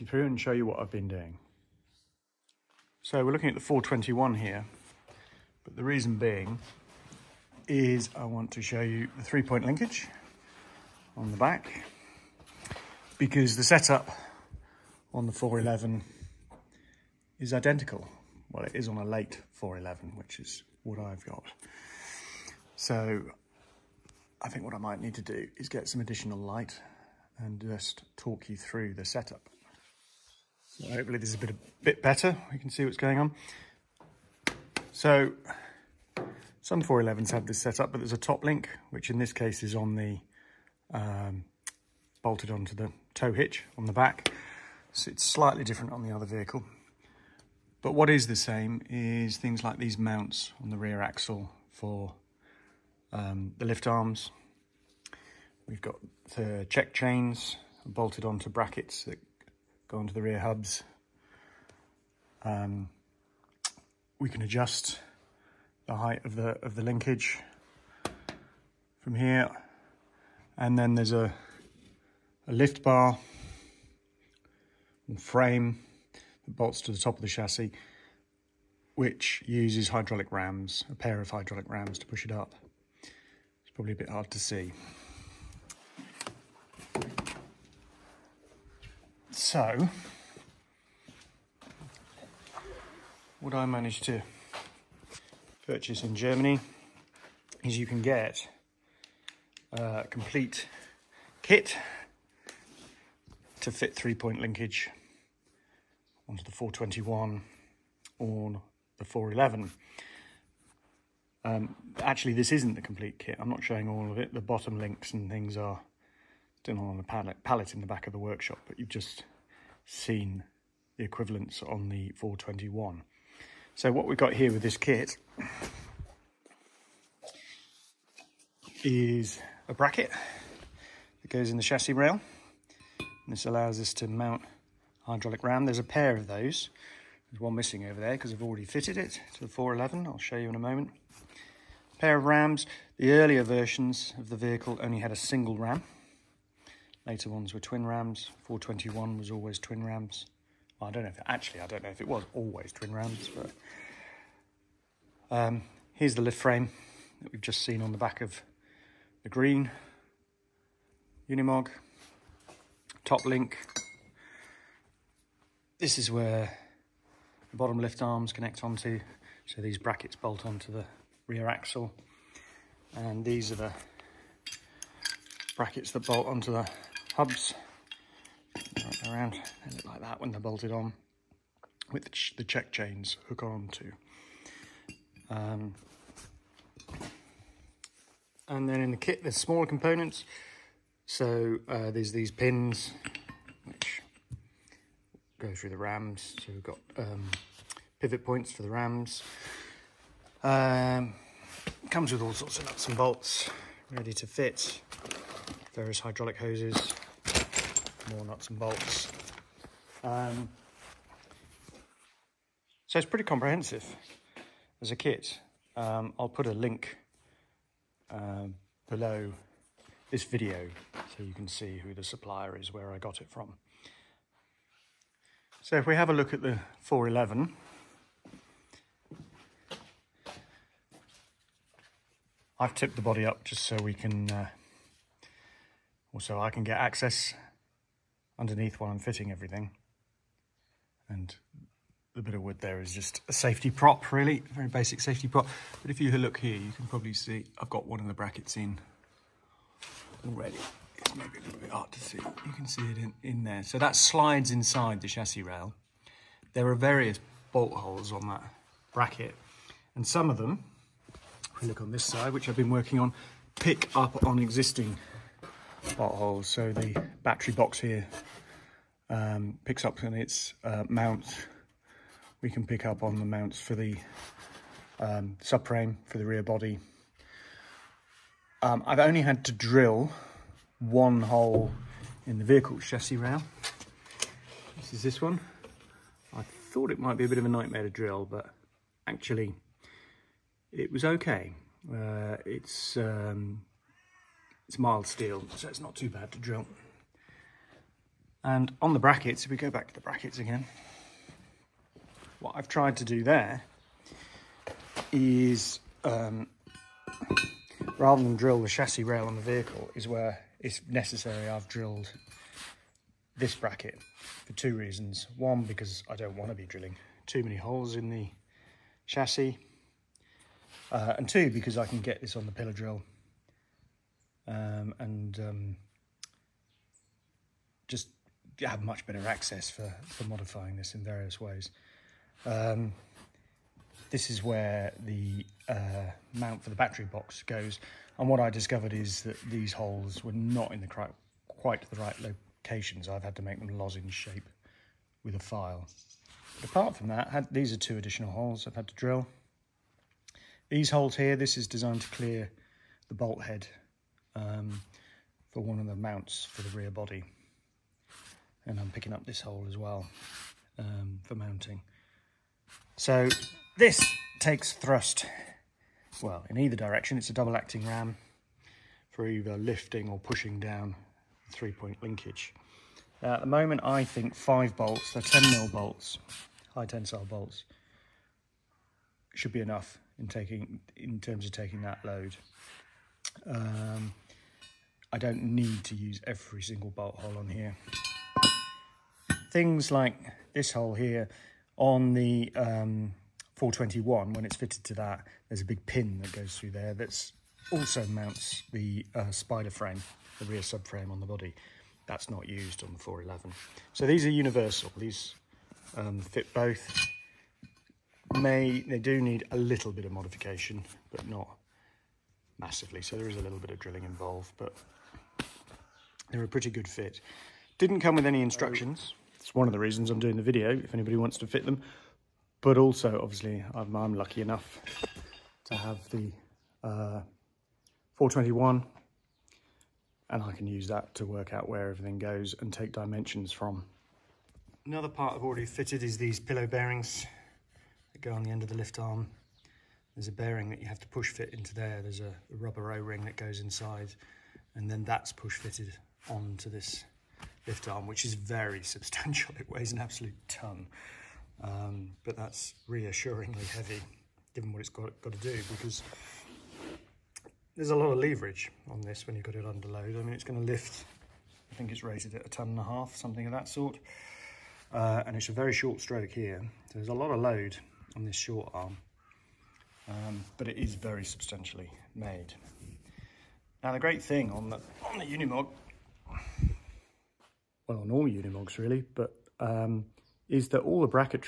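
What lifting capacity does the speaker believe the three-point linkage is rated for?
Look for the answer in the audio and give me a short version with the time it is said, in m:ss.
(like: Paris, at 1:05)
A ton and a half, at 7:42.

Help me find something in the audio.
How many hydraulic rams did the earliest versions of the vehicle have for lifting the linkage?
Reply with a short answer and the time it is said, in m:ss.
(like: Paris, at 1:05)
A single ram, at 2:25.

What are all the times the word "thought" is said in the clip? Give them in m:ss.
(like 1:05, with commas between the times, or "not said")
4:46.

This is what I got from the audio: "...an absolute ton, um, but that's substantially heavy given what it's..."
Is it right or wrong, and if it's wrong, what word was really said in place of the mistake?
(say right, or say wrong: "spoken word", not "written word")
wrong: "reassuringly", not "substantially".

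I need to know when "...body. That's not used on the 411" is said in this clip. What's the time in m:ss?
6:41.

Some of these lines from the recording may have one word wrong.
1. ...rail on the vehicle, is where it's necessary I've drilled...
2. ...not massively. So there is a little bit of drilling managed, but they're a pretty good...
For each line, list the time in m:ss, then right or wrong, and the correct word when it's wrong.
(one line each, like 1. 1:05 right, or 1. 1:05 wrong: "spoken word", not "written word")
1. 5:09 right
2. 6:51 wrong: "involved", not "managed".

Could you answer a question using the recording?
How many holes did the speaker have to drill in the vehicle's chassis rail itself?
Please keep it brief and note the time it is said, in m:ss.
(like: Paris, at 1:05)
1, at 4:40.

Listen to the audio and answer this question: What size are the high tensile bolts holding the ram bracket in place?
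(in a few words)
10 mm.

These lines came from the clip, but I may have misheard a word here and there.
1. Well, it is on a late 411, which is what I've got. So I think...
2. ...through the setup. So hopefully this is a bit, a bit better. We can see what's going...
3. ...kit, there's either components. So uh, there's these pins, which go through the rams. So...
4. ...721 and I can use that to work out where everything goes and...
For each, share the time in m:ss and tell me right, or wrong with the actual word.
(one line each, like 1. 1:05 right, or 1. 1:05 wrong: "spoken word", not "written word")
1. 0:18 right
2. 0:28 right
3. 3:08 wrong: "smaller", not "either"
4. 7:08 wrong: "421", not "721".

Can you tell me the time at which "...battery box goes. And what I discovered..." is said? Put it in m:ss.
5:36.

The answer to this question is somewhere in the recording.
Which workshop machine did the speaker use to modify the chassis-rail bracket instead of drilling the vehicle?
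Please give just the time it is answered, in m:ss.
5:22.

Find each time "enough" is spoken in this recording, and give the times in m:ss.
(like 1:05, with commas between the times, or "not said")
6:19, 7:04.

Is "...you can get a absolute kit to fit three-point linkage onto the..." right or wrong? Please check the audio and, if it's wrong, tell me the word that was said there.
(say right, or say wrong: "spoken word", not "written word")
wrong: "complete", not "absolute".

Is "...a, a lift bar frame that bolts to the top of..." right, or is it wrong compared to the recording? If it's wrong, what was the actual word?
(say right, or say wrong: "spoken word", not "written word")
right.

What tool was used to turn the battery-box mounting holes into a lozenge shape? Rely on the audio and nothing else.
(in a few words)
A file.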